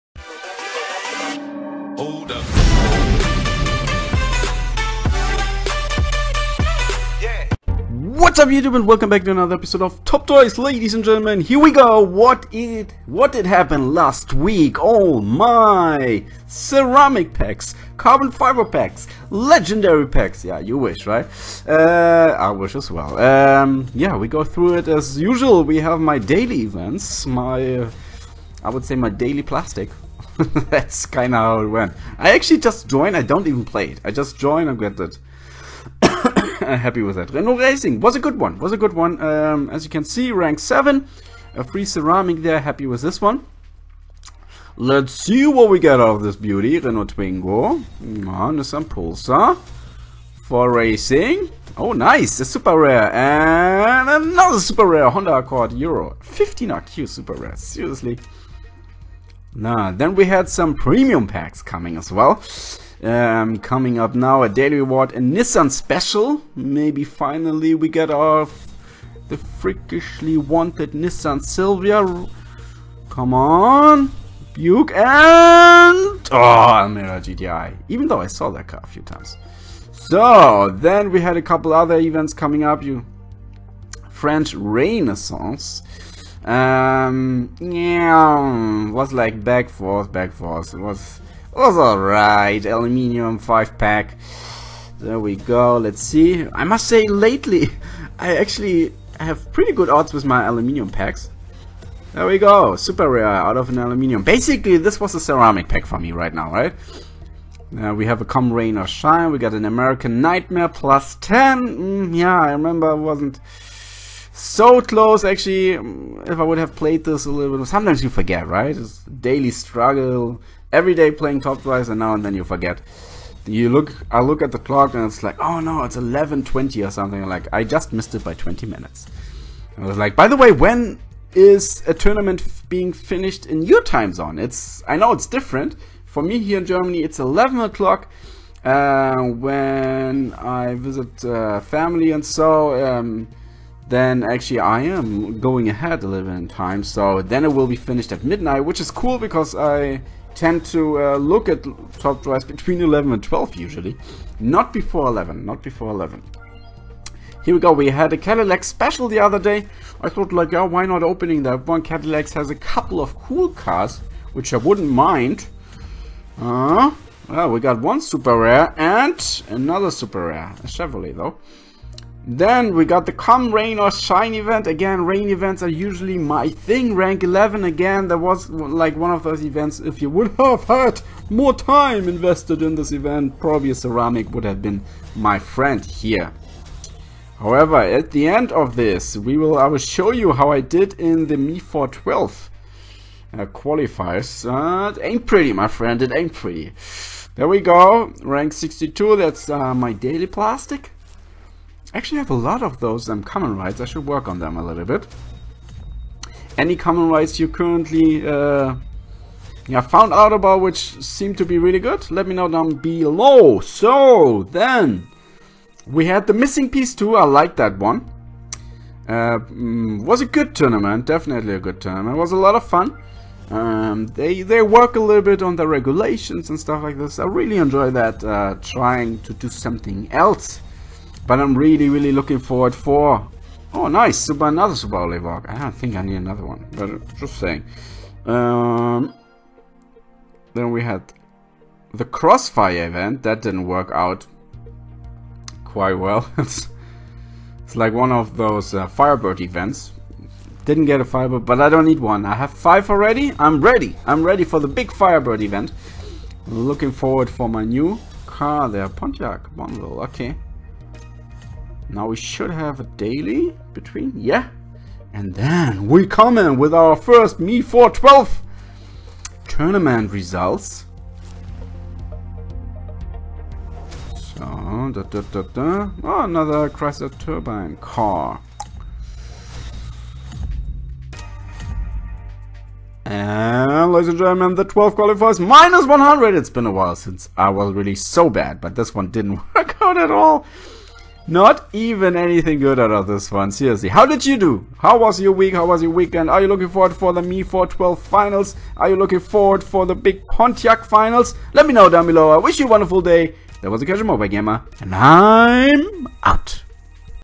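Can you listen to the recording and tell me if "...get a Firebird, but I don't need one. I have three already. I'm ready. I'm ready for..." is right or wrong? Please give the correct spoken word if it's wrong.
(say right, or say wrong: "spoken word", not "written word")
wrong: "five", not "three".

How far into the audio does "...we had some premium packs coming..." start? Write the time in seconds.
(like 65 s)
60 s.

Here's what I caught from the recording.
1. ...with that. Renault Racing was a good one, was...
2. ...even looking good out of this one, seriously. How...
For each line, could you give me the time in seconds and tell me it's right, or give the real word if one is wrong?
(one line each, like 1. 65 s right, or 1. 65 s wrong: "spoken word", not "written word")
1. 37 s right
2. 291 s wrong: "anything", not "looking".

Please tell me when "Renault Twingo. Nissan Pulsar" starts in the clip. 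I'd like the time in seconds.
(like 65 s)
46 s.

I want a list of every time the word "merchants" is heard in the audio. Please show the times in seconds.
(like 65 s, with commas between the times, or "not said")
not said.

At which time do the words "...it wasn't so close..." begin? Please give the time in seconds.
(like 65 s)
112 s.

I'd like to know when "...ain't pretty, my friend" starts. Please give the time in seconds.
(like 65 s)
195 s.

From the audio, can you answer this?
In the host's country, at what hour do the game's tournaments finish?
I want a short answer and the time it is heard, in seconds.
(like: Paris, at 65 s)
11 o'clock, at 137 s.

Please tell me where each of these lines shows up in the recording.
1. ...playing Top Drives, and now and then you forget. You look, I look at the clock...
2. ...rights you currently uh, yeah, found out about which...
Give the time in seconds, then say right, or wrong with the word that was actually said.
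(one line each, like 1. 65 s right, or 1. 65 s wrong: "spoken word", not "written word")
1. 121 s right
2. 207 s right.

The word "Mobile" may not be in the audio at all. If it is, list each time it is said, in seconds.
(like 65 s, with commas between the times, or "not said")
304 s.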